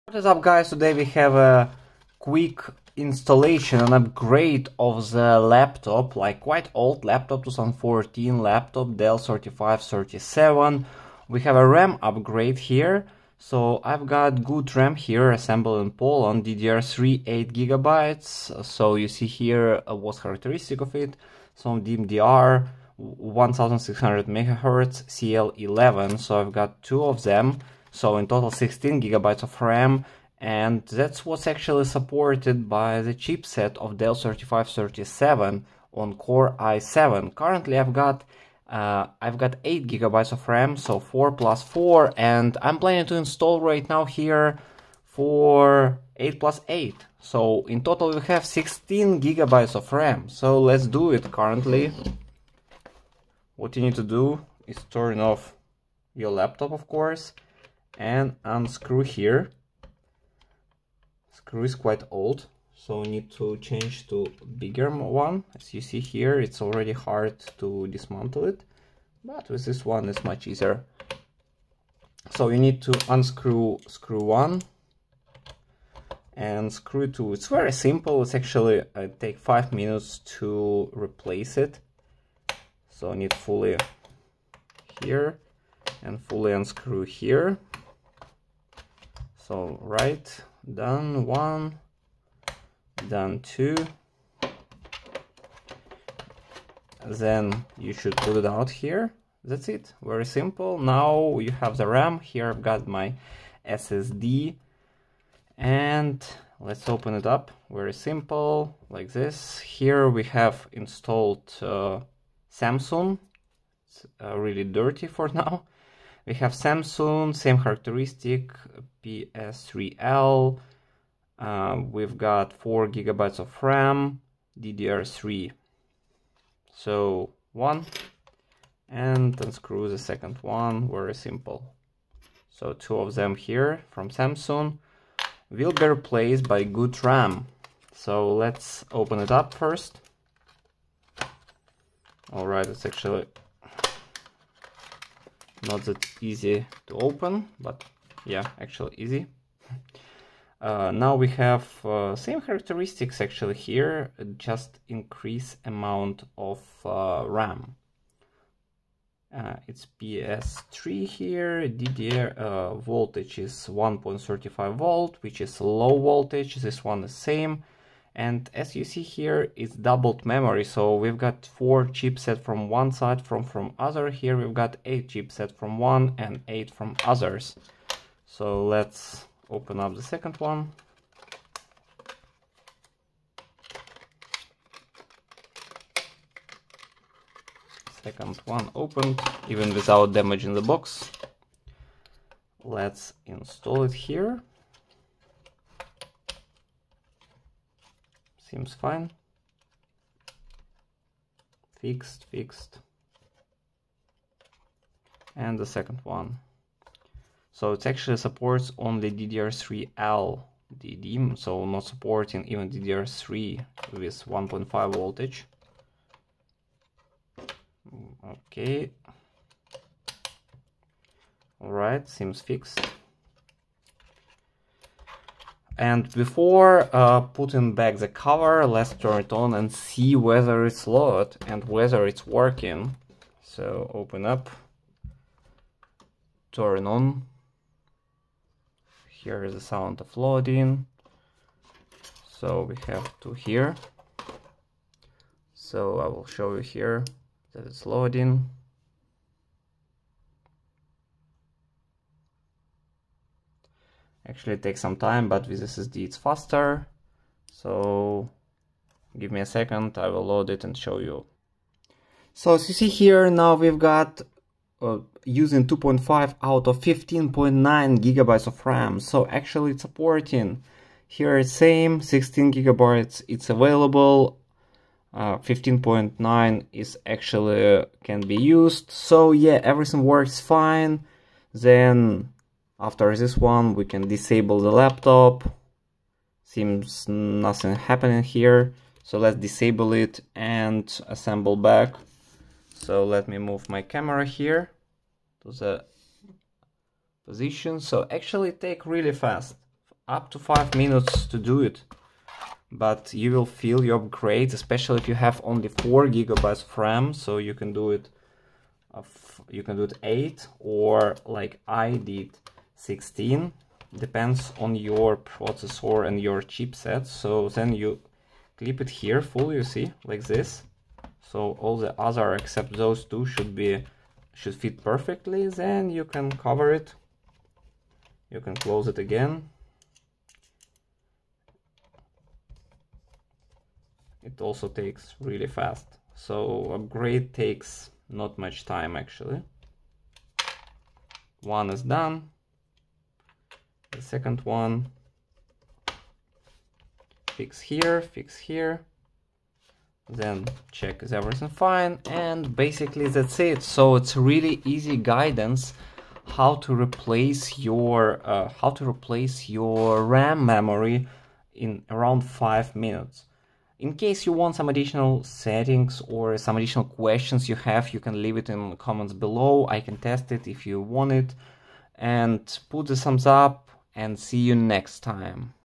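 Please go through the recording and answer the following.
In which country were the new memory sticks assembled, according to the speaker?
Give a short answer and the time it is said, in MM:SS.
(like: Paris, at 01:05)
Poland, at 00:15.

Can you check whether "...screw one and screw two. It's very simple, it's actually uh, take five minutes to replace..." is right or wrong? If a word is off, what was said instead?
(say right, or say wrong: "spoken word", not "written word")
right.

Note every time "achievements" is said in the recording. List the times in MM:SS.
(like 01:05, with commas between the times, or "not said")
not said.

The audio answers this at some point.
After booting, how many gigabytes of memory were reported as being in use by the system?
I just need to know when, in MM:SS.
04:25.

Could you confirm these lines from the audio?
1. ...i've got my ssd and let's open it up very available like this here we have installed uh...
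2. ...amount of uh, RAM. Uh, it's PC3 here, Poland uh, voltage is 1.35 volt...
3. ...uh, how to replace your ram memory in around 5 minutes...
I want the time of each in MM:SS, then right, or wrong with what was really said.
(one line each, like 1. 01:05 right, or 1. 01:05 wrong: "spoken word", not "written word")
1. 01:42 wrong: "simple", not "available"
2. 02:35 wrong: "DDR", not "Poland"
3. 05:58 right.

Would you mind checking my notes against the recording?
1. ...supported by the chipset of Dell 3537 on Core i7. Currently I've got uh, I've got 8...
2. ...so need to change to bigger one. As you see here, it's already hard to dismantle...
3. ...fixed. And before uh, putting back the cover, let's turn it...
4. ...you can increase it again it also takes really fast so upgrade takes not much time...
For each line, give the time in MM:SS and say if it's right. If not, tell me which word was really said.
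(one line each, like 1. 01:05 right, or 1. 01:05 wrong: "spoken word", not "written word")
1. 00:31 right
2. 01:02 right
3. 03:42 right
4. 05:28 wrong: "close", not "increase".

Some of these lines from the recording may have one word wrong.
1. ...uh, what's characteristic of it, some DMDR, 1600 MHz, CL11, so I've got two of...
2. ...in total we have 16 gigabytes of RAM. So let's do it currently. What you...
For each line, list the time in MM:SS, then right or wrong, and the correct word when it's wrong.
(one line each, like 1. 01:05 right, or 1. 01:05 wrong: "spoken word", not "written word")
1. 00:19 right
2. 00:47 right.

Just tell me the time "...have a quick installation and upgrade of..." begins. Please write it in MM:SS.
00:01.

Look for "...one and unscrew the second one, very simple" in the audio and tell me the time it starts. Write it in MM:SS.
02:07.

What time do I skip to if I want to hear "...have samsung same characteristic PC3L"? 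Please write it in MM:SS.
01:56.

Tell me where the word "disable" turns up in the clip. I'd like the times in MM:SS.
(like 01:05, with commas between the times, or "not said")
04:44, 04:49.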